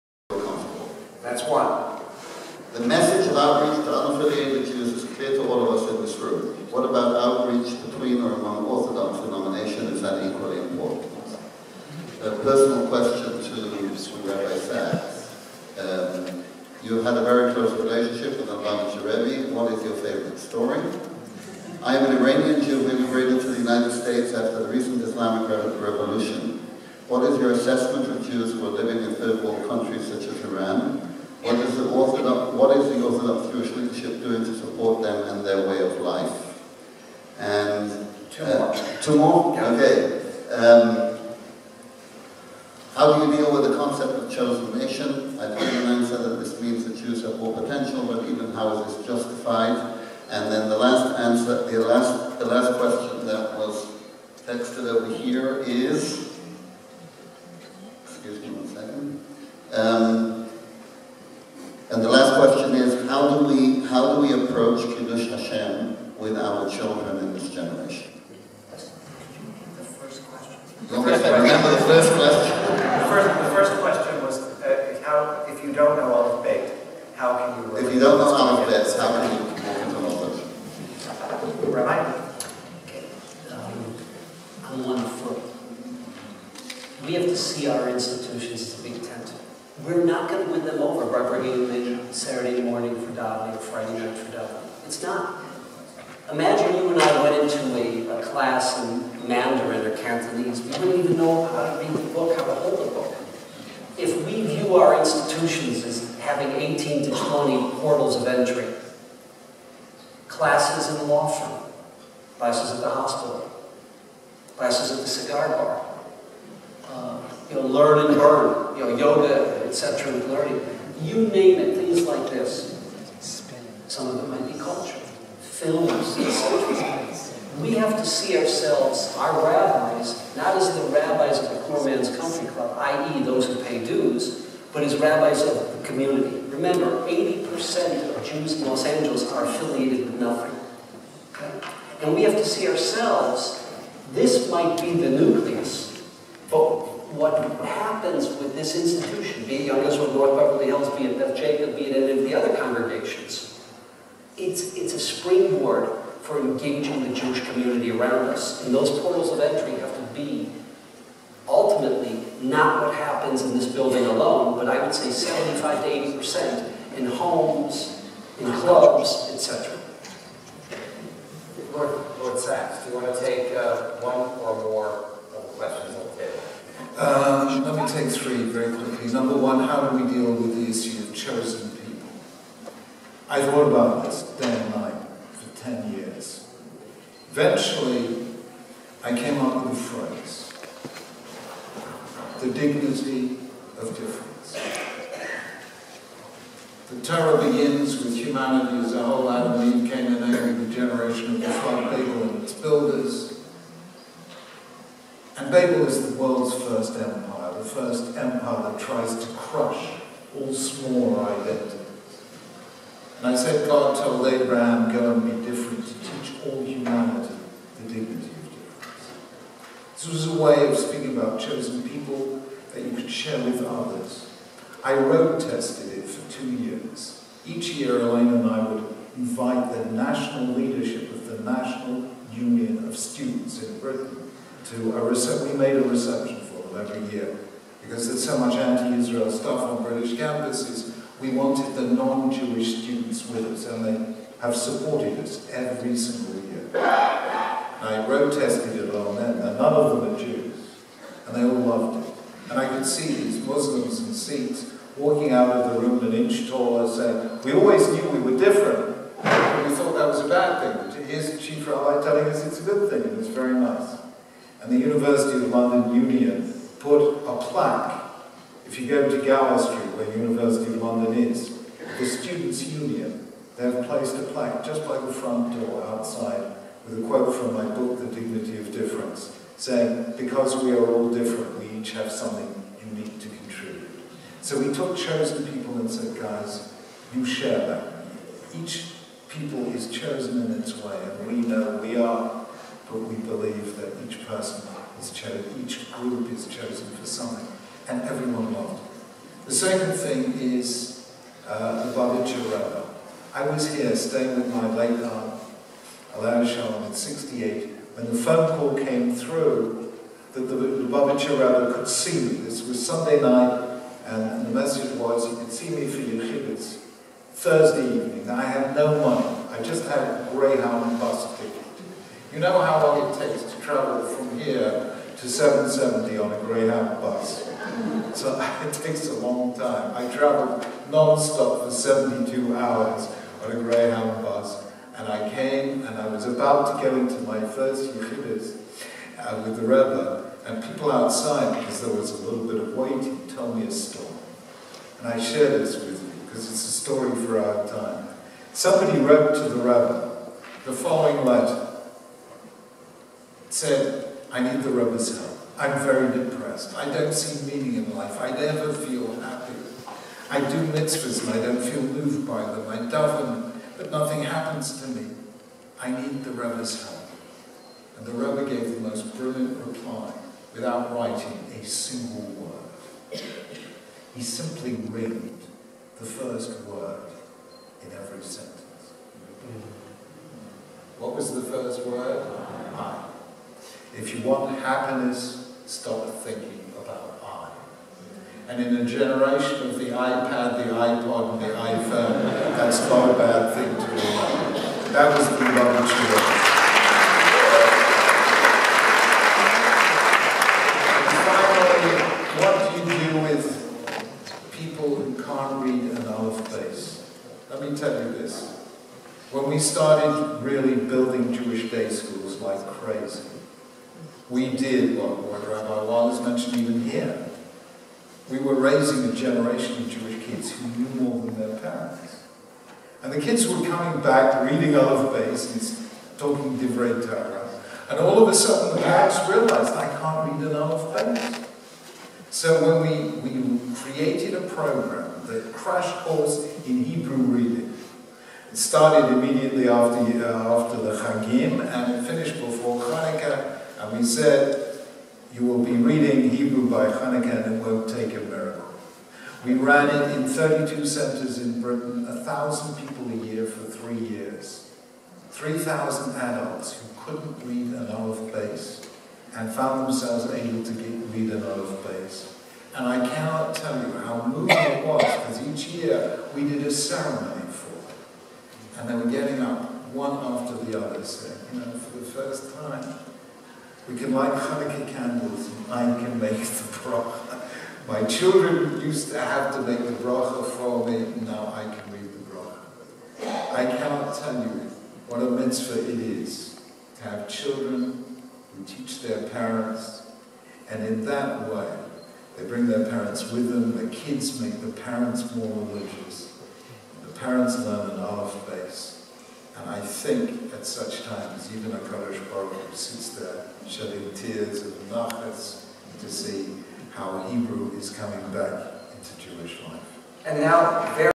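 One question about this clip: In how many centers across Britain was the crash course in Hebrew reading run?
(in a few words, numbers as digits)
32.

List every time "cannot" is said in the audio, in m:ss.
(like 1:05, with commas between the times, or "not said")
7:43, 8:03.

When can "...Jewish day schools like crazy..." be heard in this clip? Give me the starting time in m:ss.
6:51.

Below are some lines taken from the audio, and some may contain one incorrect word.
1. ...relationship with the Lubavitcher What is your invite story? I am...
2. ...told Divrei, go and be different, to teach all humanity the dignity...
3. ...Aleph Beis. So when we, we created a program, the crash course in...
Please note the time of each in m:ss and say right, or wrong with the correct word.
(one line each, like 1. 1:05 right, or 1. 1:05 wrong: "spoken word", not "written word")
1. 0:17 wrong: "favorite", not "invite"
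2. 3:33 wrong: "Abraham", not "Divrei"
3. 7:10 right.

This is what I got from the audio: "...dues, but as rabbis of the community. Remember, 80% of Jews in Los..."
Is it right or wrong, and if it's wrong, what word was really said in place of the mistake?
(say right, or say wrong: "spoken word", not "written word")
right.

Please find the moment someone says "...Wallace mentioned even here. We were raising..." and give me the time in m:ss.
6:55.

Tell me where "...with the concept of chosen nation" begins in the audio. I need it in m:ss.
0:43.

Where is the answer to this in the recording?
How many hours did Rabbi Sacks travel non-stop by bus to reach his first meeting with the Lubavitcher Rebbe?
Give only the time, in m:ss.
5:31.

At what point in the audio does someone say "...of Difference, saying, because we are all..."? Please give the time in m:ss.
4:38.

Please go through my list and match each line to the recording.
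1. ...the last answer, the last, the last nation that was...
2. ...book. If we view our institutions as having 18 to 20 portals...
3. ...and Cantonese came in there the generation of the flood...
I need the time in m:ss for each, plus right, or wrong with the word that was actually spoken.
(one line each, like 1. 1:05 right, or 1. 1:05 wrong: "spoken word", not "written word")
1. 0:50 wrong: "question", not "nation"
2. 1:42 right
3. 3:19 wrong: "Eve", not "Cantonese".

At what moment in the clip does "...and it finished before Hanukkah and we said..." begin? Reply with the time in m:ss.
7:21.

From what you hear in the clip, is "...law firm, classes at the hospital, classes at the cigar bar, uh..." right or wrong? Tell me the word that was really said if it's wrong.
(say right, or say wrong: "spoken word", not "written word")
right.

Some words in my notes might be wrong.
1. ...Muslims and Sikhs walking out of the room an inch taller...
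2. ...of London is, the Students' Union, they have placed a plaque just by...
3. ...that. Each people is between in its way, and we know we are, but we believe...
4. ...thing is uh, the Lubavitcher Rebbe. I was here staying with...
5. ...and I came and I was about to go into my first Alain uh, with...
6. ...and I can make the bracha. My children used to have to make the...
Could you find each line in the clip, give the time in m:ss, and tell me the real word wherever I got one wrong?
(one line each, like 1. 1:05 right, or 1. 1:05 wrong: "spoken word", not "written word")
1. 4:13 right
2. 4:30 right
3. 4:47 wrong: "chosen", not "between"
4. 4:59 right
5. 5:34 wrong: "Yechidus", not "Alain"
6. 7:55 right.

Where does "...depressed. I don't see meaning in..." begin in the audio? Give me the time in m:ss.
5:56.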